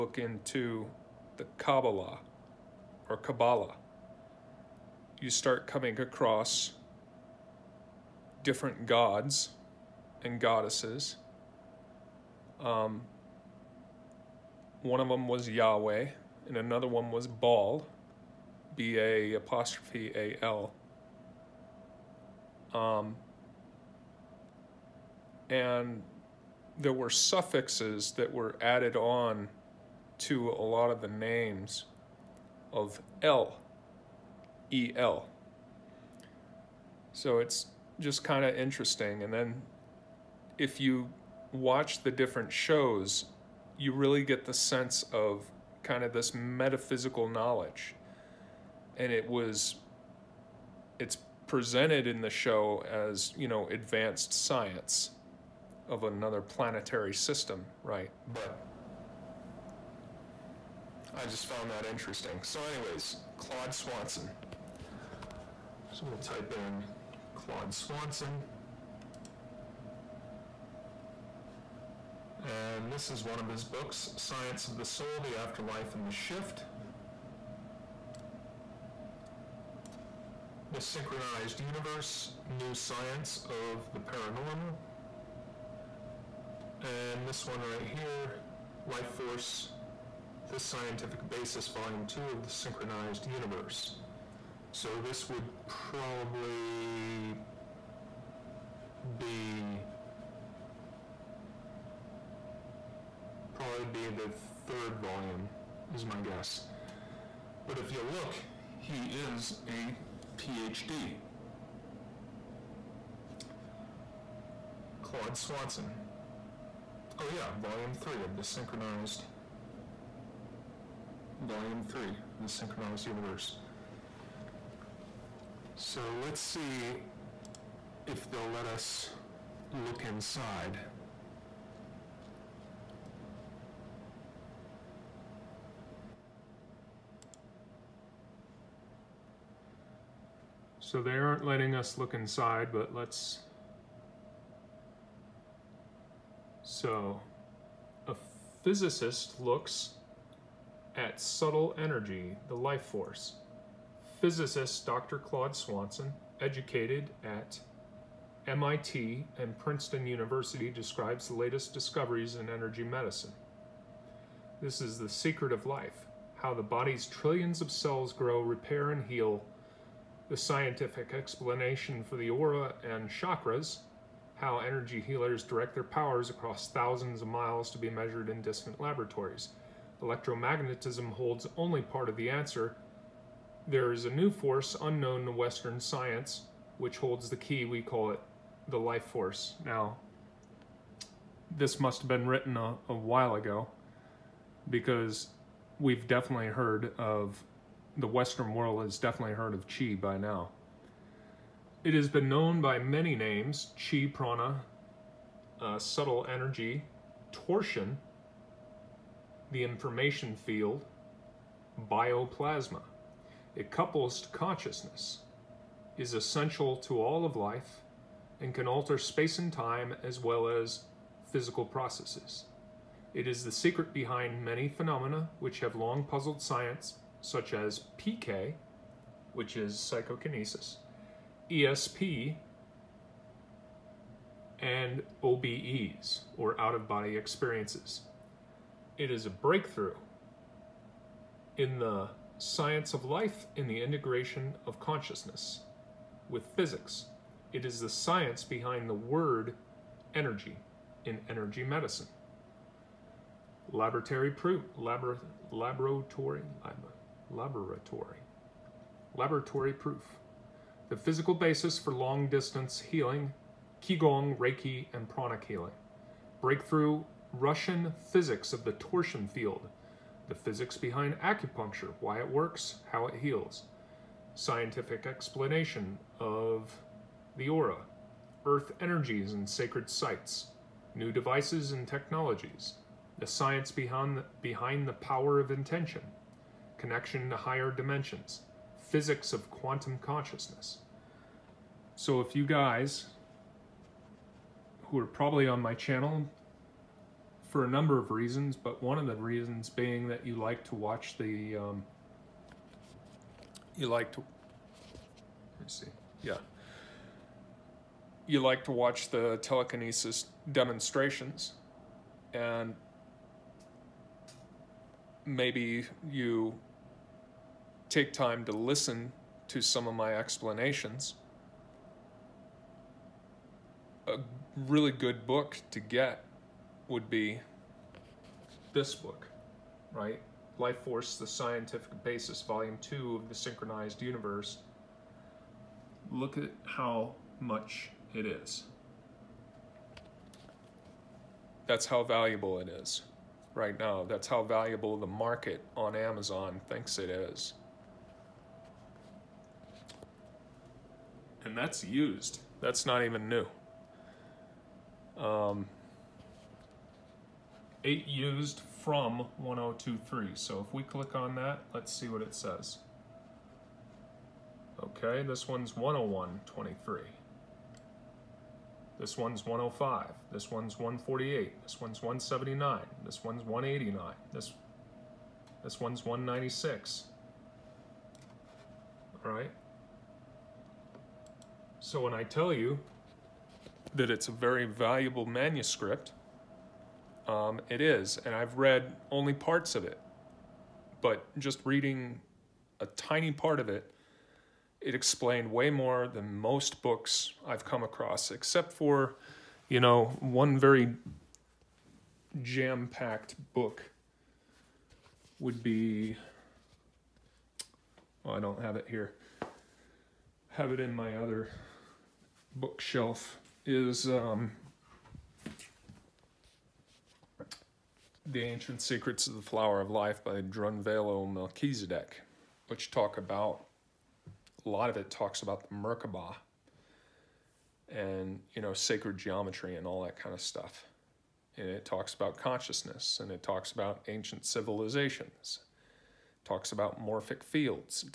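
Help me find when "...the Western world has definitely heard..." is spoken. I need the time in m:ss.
3:17.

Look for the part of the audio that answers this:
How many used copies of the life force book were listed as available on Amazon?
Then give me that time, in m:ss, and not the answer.
5:57.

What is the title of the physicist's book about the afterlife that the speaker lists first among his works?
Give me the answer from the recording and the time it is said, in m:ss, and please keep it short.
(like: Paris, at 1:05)
Science of the Soul, at 1:14.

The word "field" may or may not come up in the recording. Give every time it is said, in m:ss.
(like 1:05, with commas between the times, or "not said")
3:30, 4:29, 7:17.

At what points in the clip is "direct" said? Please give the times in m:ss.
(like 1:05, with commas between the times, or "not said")
2:55.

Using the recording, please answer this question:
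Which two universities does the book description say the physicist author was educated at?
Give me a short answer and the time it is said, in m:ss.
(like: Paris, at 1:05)
MIT and Princeton, at 2:38.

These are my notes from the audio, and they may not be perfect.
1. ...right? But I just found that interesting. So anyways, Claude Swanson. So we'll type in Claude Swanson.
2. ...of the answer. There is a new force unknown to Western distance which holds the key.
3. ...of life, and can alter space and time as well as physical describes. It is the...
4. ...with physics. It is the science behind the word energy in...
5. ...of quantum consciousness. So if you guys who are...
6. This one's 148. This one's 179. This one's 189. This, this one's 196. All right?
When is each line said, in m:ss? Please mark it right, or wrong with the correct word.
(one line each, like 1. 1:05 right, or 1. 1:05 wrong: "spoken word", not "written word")
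1. 0:57 right
2. 3:02 wrong: "science", not "distance"
3. 3:37 wrong: "processes", not "describes"
4. 4:06 right
5. 4:49 right
6. 6:10 right.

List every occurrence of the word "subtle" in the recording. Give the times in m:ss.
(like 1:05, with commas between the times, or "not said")
2:31, 3:25.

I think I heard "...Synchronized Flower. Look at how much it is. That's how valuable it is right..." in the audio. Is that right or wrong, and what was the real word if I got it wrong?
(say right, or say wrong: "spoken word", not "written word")
wrong: "Universe", not "Flower".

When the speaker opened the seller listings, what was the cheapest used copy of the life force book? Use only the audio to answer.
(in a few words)
$101.23.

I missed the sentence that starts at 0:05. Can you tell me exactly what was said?
You start coming across different gods and goddesses.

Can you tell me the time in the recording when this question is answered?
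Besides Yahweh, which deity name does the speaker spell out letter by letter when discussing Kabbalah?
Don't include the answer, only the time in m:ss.
0:17.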